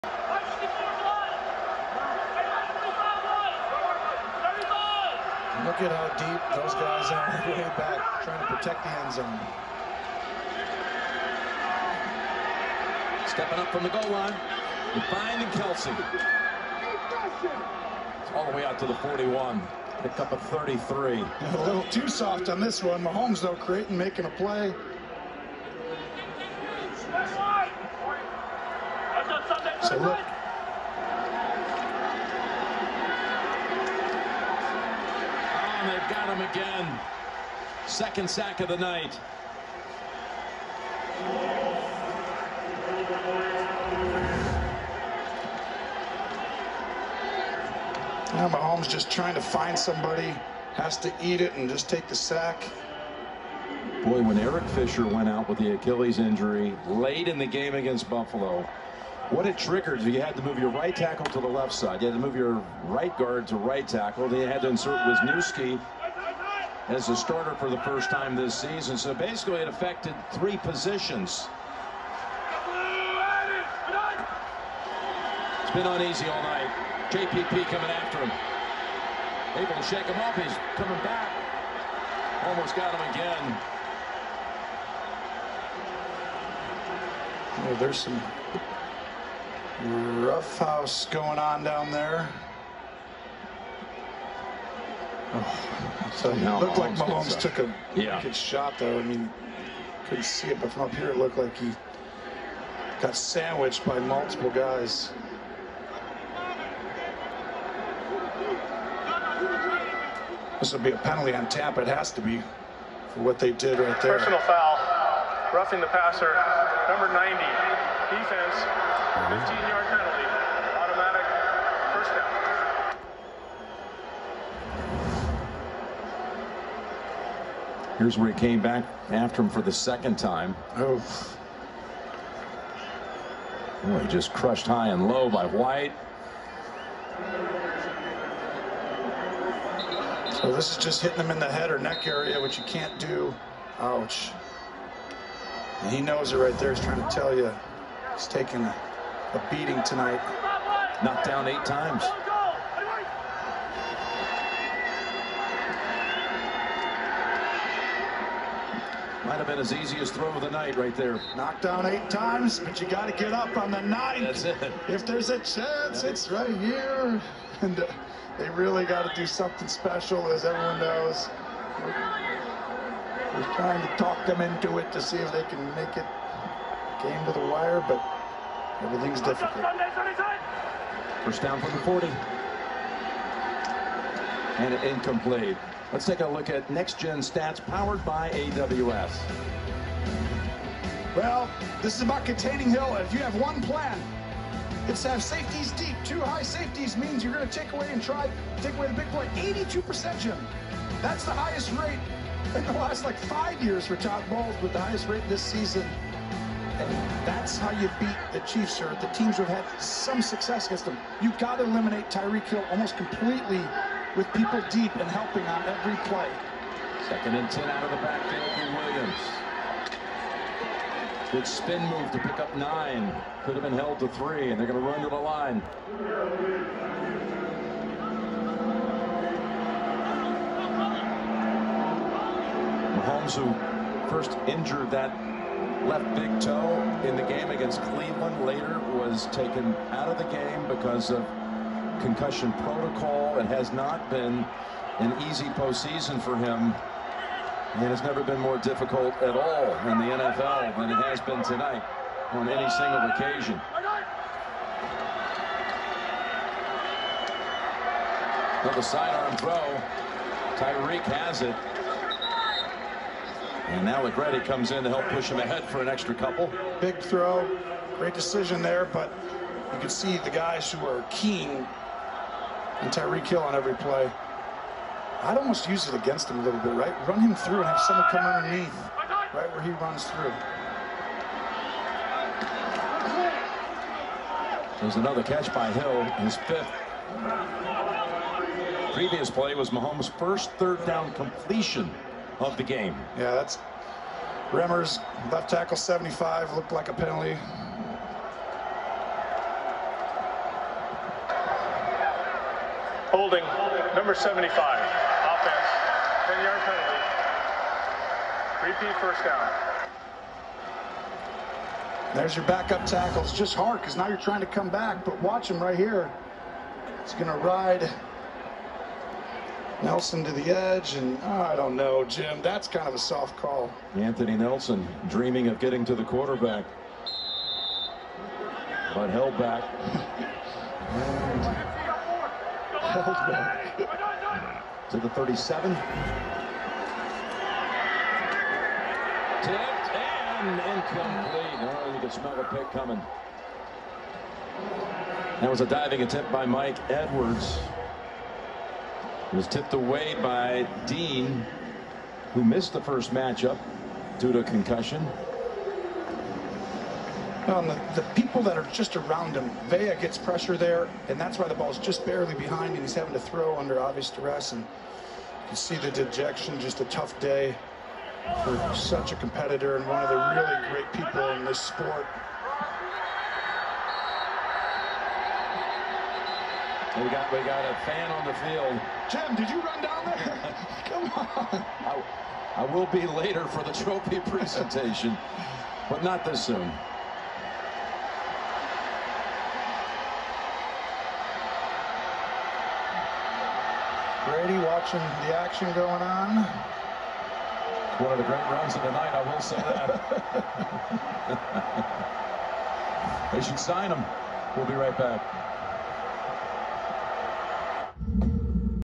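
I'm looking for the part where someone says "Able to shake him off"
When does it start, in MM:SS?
01:19.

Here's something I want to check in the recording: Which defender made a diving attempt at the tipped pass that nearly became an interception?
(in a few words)
Mike Edwards.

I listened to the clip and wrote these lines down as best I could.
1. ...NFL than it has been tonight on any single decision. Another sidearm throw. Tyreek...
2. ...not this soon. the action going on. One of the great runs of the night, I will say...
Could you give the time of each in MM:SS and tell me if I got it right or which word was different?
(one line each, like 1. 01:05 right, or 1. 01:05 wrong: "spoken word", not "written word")
1. 04:10 wrong: "occasion", not "decision"
2. 06:26 right.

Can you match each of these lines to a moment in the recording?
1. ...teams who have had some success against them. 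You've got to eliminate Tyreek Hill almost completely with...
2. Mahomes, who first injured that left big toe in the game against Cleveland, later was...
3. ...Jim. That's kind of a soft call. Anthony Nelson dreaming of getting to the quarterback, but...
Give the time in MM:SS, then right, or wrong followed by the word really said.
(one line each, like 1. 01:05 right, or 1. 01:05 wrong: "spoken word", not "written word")
1. 03:29 right
2. 03:52 right
3. 05:22 right.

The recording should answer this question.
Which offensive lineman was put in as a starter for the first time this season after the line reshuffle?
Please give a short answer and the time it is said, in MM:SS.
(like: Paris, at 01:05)
Wisniewski, at 01:05.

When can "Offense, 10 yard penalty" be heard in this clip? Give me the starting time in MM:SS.
05:04.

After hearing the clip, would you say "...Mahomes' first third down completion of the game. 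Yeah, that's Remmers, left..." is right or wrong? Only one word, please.
right.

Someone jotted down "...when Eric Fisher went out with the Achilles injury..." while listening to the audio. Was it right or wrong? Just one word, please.
right.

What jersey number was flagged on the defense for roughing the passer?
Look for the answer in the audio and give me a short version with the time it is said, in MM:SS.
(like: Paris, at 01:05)
90, at 01:56.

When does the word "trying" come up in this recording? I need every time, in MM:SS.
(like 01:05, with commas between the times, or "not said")
00:08, 00:49, 02:26, 02:53, 05:14.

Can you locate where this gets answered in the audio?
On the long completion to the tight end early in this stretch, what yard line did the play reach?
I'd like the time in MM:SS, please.
00:18.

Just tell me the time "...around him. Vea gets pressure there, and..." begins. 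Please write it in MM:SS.
05:58.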